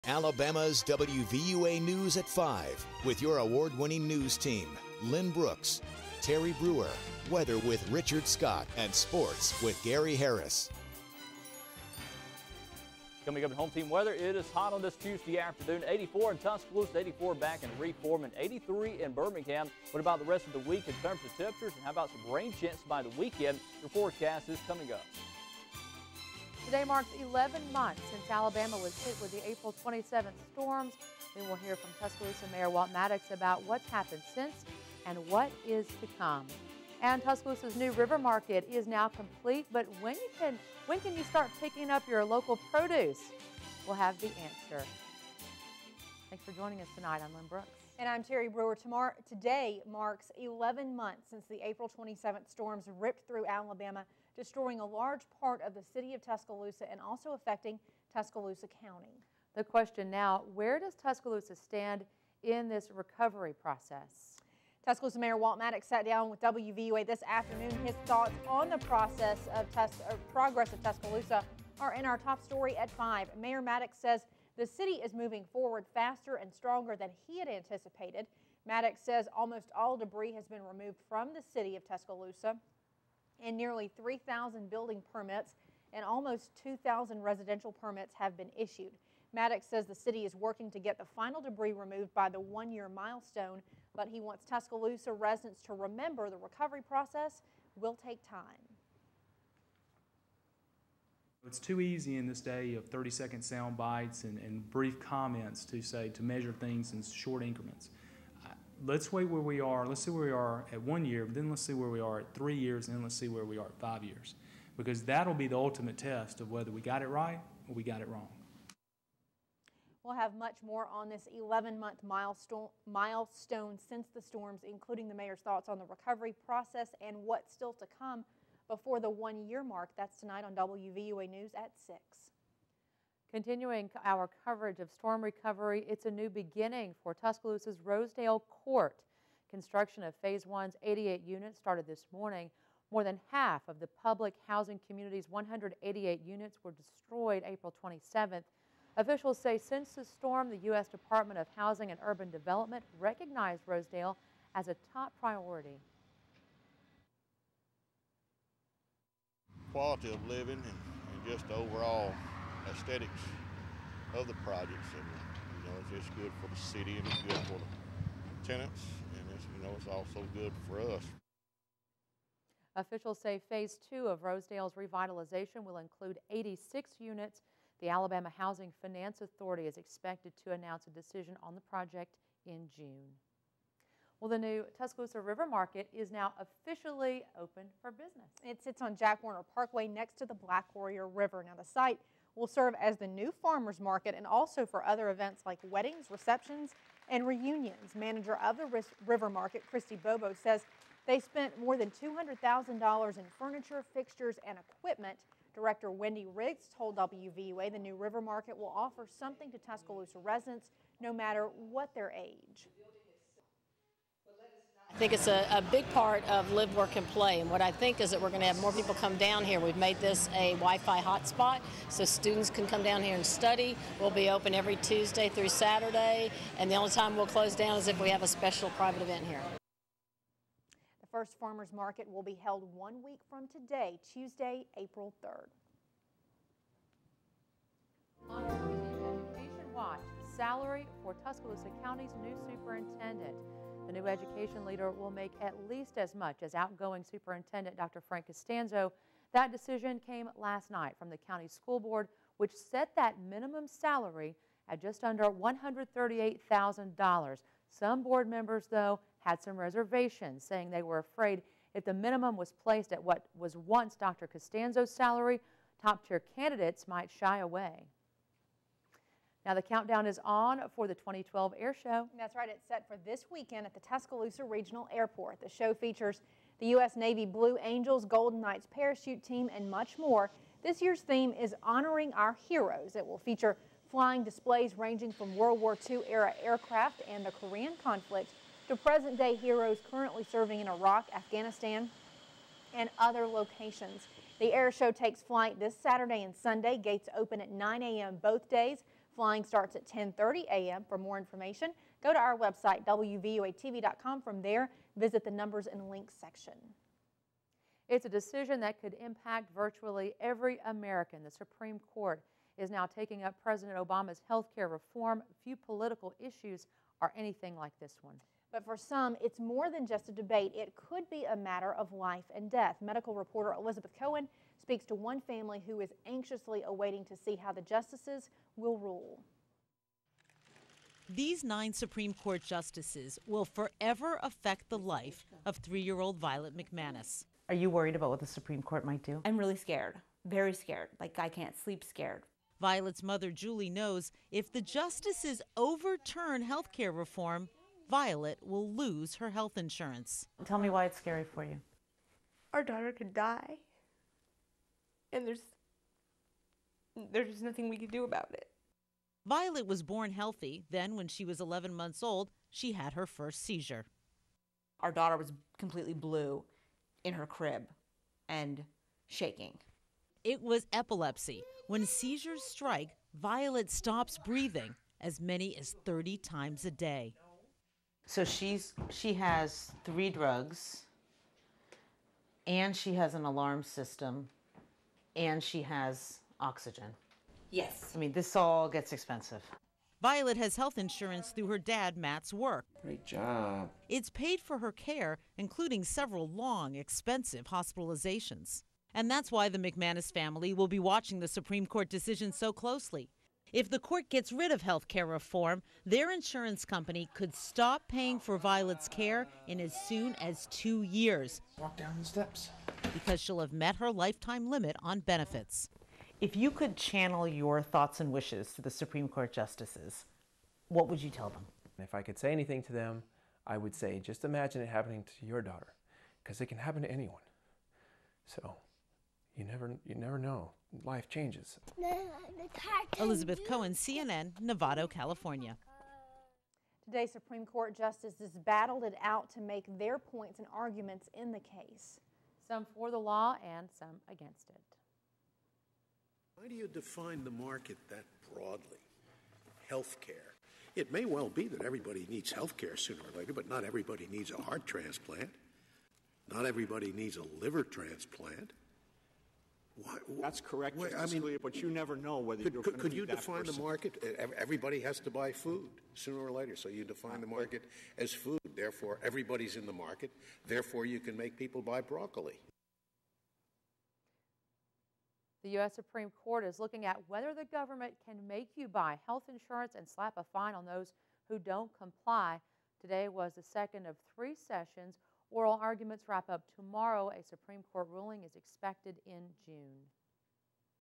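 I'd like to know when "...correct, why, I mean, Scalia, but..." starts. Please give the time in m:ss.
7:40.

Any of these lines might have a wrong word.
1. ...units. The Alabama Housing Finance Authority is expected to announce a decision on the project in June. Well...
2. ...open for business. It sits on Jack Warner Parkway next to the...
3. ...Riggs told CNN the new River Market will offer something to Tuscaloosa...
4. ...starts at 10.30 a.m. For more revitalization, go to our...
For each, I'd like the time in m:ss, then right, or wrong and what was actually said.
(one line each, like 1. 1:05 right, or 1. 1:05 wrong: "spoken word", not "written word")
1. 2:56 right
2. 3:07 right
3. 3:26 wrong: "WVUA", not "CNN"
4. 4:59 wrong: "information", not "revitalization".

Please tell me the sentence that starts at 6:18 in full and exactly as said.
So she's she has three drugs, and she has an alarm system, and she has oxygen.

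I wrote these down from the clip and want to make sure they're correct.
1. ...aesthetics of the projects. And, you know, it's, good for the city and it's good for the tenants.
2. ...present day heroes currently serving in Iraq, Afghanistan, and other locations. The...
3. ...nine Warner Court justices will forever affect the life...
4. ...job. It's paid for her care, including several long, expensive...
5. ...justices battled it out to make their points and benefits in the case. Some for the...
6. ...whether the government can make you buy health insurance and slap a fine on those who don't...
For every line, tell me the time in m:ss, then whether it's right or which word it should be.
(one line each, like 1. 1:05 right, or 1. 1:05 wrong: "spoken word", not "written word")
1. 2:42 right
2. 4:48 right
3. 5:31 wrong: "Supreme", not "Warner"
4. 6:33 right
5. 7:17 wrong: "arguments", not "benefits"
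6. 7:57 right.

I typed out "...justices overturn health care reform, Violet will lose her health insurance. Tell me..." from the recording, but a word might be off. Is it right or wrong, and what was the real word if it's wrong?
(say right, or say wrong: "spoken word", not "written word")
right.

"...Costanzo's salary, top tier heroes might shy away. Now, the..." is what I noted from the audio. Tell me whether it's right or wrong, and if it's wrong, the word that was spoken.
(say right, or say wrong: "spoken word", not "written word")
wrong: "candidates", not "heroes".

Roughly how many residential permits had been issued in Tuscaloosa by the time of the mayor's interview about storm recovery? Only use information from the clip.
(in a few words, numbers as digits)
2,000.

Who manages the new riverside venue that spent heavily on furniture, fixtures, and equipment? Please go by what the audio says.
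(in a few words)
Christy Bobo.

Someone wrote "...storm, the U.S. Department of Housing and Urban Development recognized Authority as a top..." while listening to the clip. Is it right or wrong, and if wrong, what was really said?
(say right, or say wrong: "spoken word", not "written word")
wrong: "Rosedale", not "Authority".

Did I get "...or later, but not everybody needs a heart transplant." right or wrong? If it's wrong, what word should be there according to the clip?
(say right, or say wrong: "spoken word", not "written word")
right.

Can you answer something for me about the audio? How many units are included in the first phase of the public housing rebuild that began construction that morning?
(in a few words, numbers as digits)
88.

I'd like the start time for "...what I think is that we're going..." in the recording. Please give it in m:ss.
3:37.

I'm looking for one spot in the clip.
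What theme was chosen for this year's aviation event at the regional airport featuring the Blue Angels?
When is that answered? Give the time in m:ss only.
4:41.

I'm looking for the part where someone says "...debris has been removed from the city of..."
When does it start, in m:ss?
1:19.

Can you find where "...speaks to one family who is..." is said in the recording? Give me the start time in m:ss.
5:24.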